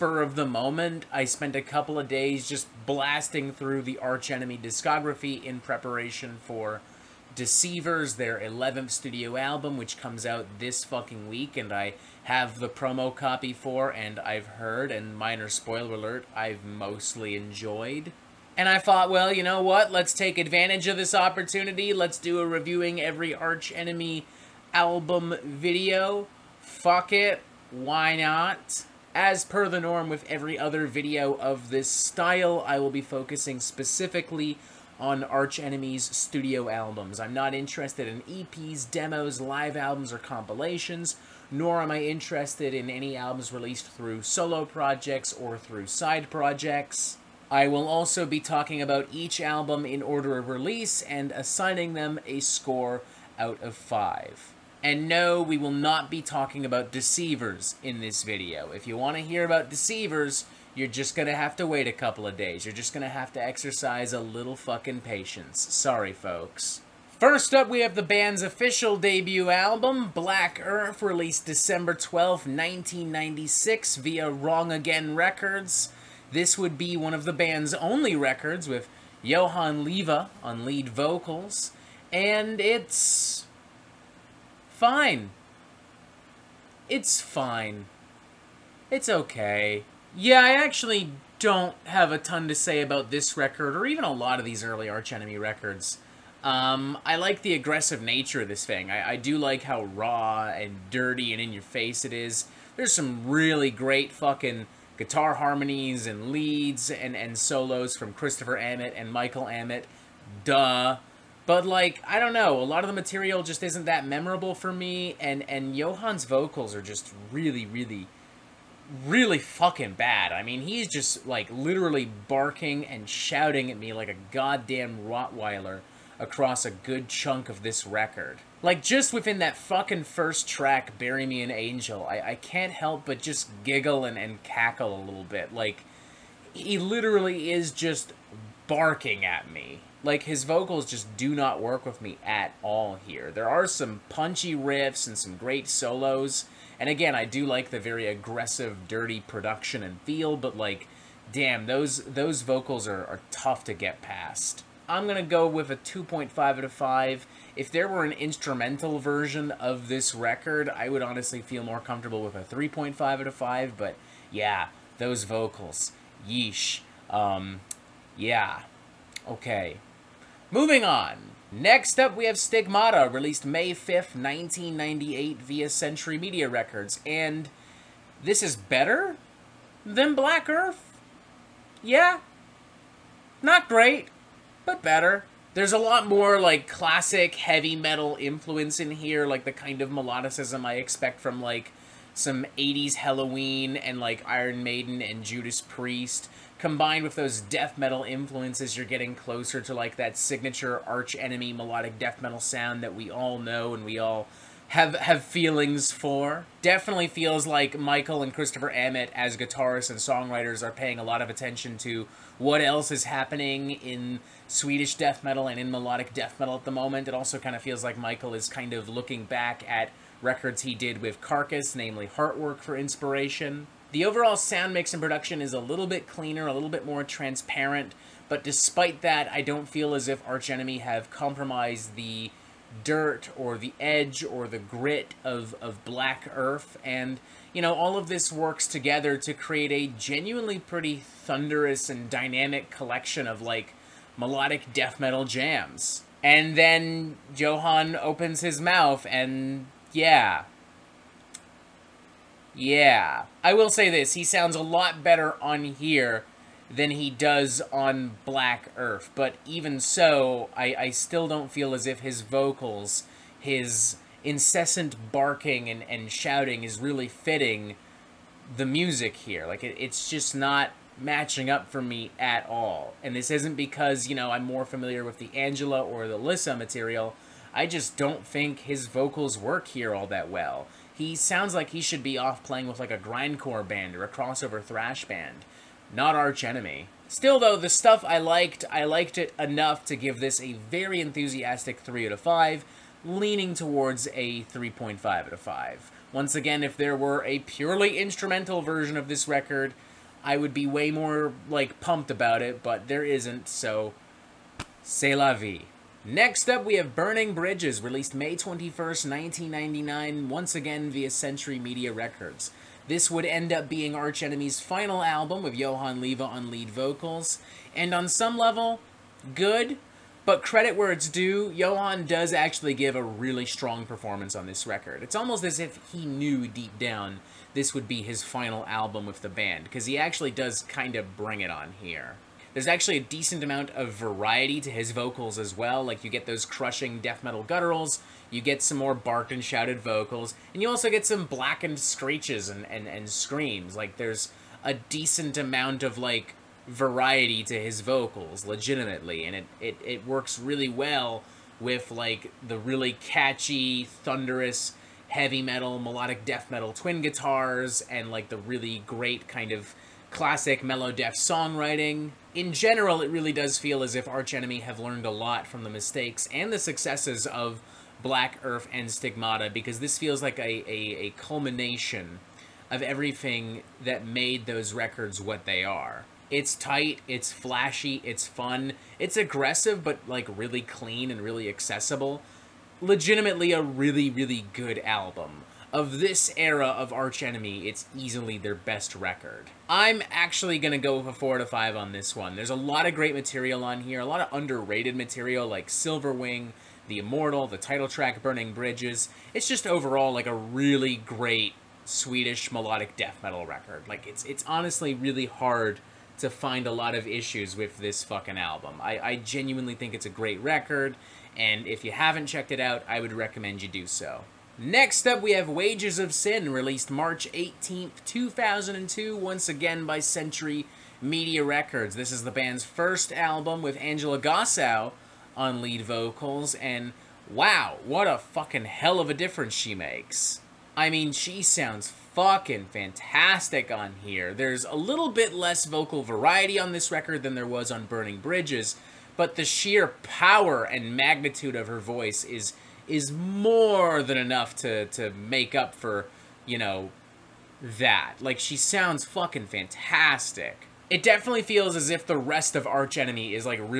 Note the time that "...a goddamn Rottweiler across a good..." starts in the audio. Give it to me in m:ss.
2:04.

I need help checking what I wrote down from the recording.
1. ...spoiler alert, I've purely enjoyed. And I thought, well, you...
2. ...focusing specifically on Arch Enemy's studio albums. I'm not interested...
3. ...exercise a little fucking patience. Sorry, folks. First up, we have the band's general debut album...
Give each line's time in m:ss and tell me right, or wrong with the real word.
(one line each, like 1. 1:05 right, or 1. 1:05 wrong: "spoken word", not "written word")
1. 0:15 wrong: "mostly", not "purely"
2. 0:32 right
3. 1:03 wrong: "official", not "general".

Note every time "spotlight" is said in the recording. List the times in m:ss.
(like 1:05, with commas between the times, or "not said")
not said.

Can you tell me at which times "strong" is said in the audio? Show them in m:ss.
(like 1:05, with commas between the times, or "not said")
5:23.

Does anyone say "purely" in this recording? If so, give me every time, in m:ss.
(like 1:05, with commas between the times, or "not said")
4:57.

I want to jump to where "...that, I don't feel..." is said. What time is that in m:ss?
3:49.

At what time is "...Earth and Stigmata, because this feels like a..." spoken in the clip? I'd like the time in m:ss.
6:08.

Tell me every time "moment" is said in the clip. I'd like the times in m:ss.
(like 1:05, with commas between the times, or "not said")
0:00, 3:36.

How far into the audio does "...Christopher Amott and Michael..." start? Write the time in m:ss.
1:48.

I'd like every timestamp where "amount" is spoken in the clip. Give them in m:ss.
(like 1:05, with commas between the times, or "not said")
5:33, 5:45.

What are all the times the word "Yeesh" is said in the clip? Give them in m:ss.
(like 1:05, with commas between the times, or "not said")
2:46.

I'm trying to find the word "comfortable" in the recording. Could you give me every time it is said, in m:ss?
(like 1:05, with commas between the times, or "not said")
2:41.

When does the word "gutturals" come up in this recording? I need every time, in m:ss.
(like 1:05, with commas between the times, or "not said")
5:37.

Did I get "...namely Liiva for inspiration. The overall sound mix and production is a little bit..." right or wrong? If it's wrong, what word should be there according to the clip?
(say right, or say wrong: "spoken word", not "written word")
wrong: "Heartwork", not "Liiva".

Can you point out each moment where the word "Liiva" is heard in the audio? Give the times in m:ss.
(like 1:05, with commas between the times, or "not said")
1:19, 5:15.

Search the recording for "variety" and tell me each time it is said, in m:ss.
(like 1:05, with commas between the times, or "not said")
5:33, 5:46, 7:16.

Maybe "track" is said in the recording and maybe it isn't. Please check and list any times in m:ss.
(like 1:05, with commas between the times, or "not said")
2:10, 6:37.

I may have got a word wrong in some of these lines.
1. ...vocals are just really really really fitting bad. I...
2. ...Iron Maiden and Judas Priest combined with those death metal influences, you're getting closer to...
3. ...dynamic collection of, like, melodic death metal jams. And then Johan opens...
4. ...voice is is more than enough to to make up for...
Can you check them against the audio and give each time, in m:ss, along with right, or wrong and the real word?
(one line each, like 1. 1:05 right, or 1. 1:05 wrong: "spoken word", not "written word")
1. 1:56 wrong: "fucking", not "fitting"
2. 3:14 right
3. 4:02 right
4. 7:21 right.